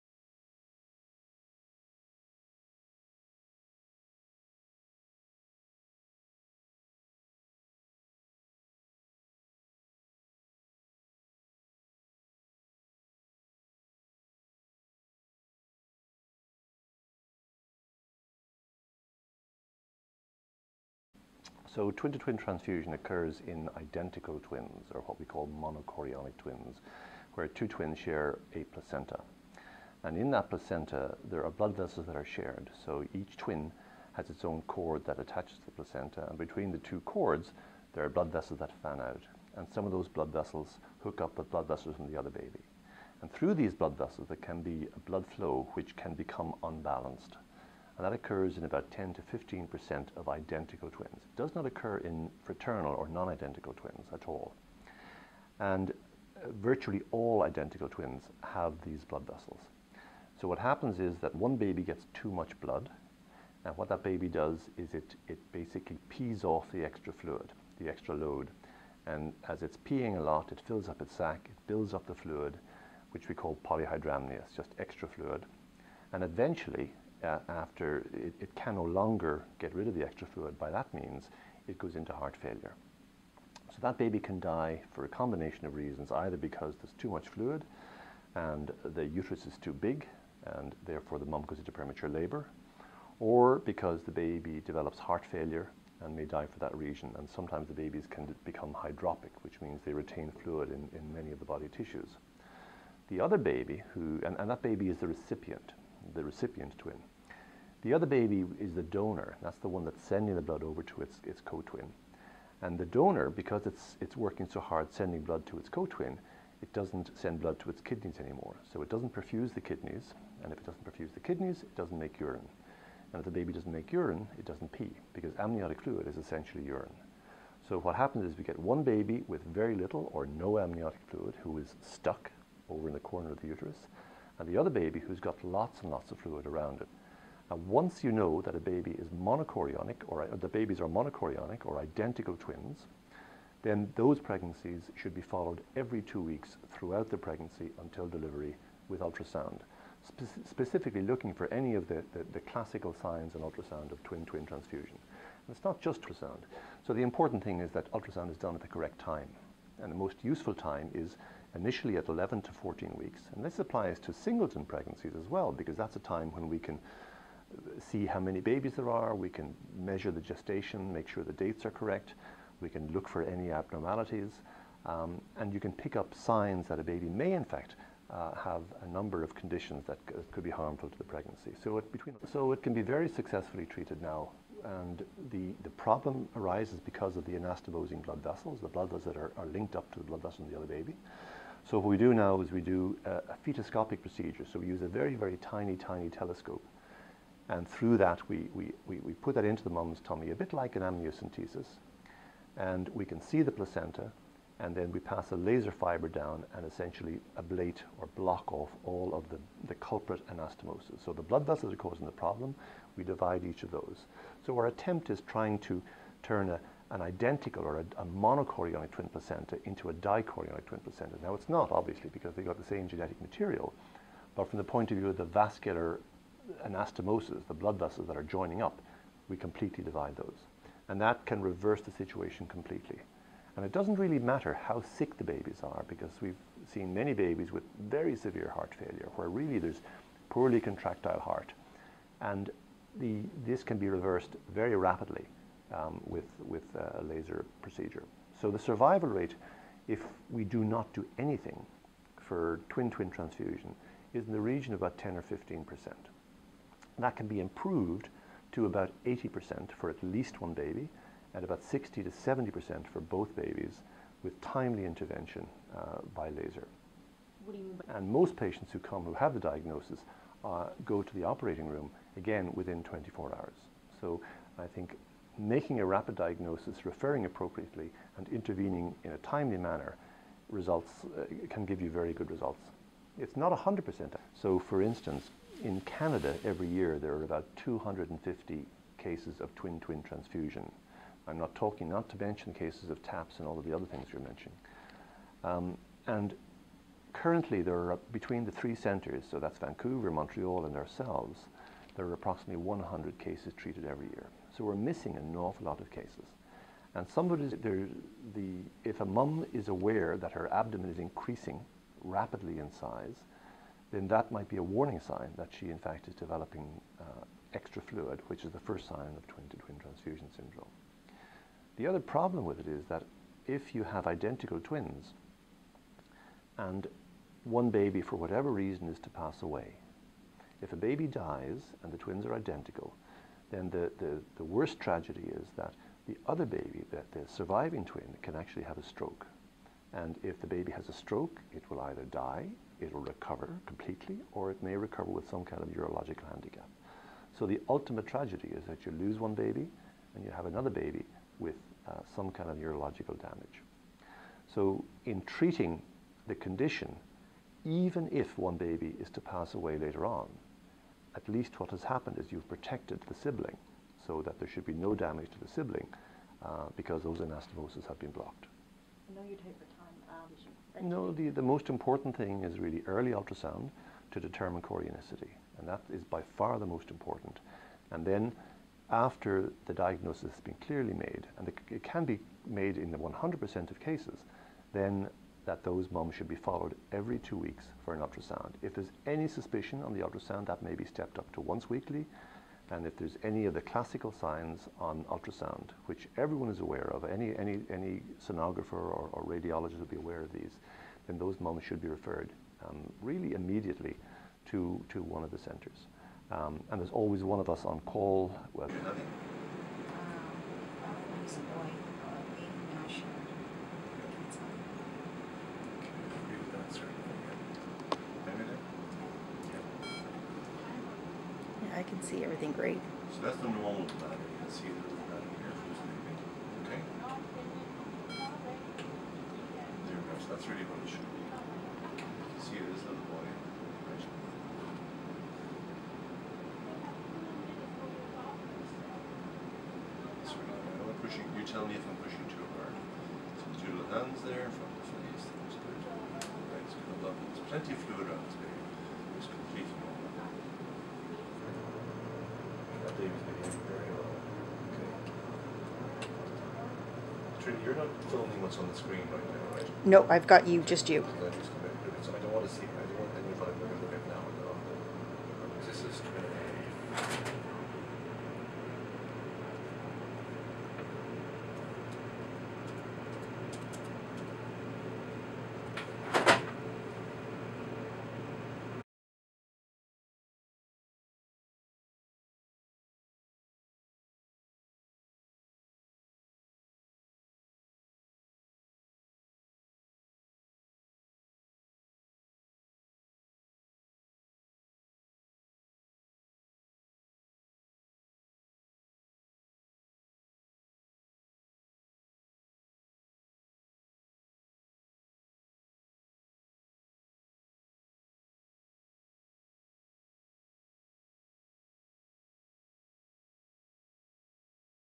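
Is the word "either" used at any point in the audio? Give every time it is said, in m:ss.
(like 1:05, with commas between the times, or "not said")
1:26, 5:41.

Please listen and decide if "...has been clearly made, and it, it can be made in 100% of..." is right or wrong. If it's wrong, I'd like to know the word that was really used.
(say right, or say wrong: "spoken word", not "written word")
right.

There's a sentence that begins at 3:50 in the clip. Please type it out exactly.
And that can reverse the situation completely.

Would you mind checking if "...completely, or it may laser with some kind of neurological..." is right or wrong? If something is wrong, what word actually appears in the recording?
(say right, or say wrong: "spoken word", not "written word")
wrong: "recover", not "laser".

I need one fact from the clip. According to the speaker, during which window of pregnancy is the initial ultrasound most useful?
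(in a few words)
11 to 14 weeks.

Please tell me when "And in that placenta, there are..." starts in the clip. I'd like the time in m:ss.
0:30.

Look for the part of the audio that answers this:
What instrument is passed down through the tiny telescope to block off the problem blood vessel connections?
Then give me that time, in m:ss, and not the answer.
3:25.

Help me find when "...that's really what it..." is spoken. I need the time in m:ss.
7:10.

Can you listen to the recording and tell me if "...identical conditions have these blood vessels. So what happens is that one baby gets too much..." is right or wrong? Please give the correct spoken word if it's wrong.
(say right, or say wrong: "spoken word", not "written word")
wrong: "twins", not "conditions".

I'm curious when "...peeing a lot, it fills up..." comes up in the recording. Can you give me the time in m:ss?
1:09.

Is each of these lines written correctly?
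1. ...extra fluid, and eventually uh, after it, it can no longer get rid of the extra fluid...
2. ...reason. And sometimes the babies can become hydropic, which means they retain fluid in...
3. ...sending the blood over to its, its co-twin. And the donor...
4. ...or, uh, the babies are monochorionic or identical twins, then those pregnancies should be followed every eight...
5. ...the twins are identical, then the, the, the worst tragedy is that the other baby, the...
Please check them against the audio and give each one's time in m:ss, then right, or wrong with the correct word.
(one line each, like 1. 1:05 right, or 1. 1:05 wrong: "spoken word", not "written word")
1. 1:14 right
2. 1:36 right
3. 1:50 right
4. 2:20 wrong: "two", not "eight"
5. 5:31 right.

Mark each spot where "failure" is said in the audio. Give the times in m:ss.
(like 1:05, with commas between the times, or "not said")
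1:22, 1:35, 3:58.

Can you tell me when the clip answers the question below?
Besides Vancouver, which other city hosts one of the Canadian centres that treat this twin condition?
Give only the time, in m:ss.
5:00.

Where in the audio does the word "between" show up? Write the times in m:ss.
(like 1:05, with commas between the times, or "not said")
0:36, 3:01, 4:58.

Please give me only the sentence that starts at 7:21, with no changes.
You tell me if I'm pushing too hard.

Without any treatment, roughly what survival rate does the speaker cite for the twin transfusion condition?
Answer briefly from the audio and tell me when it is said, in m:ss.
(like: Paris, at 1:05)
10 or 15 percent, at 4:14.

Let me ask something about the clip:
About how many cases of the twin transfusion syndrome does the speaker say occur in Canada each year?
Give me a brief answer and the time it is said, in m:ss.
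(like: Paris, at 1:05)
250, at 4:47.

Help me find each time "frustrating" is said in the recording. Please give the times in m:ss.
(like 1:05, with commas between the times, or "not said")
not said.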